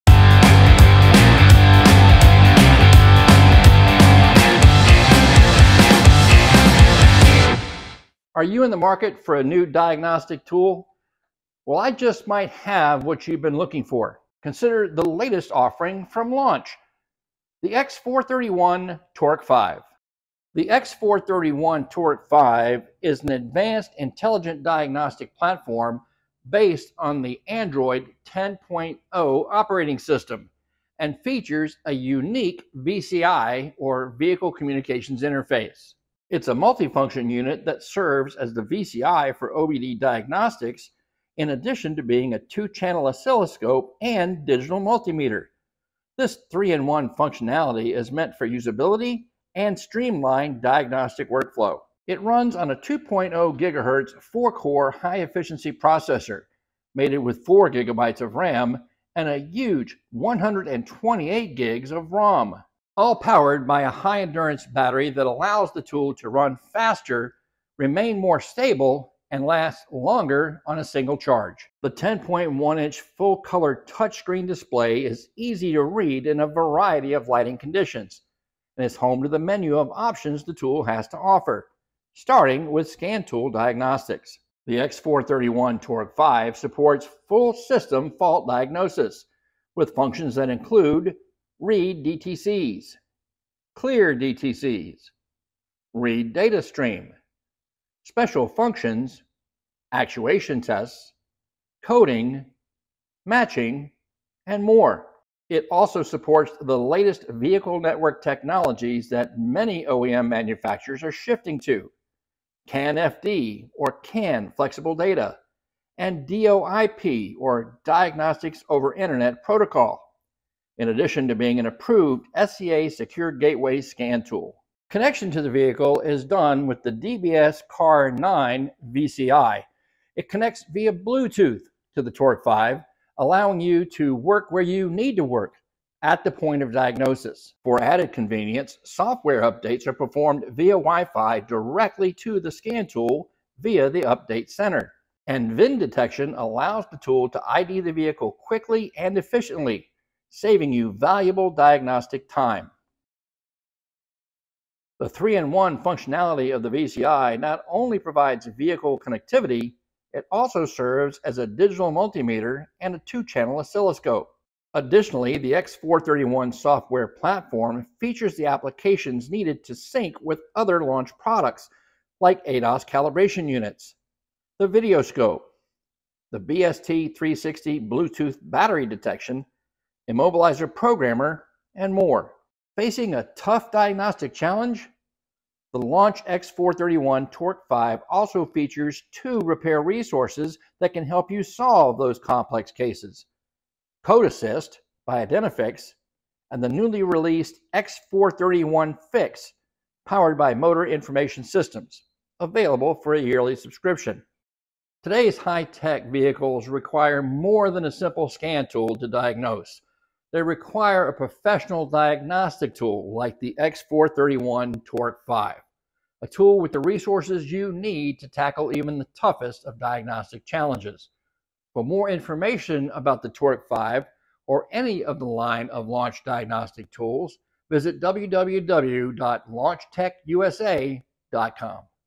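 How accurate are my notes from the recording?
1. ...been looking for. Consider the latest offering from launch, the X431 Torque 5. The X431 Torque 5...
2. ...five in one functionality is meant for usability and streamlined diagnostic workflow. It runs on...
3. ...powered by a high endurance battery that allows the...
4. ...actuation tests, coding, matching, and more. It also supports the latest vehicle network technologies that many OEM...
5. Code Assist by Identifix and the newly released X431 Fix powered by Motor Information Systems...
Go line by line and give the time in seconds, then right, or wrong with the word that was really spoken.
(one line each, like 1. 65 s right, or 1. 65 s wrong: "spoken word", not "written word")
1. 13 s right
2. 46 s wrong: "three", not "five"
3. 63 s right
4. 99 s right
5. 194 s right.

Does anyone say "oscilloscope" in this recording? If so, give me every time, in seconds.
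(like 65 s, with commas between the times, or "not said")
43 s, 163 s.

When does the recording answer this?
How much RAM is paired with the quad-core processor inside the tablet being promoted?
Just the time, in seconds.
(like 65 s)
57 s.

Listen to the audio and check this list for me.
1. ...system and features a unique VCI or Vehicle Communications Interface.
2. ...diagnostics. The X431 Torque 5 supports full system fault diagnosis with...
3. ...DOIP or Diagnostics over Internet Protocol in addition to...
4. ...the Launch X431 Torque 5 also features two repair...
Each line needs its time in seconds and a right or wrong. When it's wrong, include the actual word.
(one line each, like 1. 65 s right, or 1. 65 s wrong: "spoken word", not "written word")
1. 29 s right
2. 83 s right
3. 116 s right
4. 185 s right.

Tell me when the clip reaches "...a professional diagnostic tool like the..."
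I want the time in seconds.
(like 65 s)
211 s.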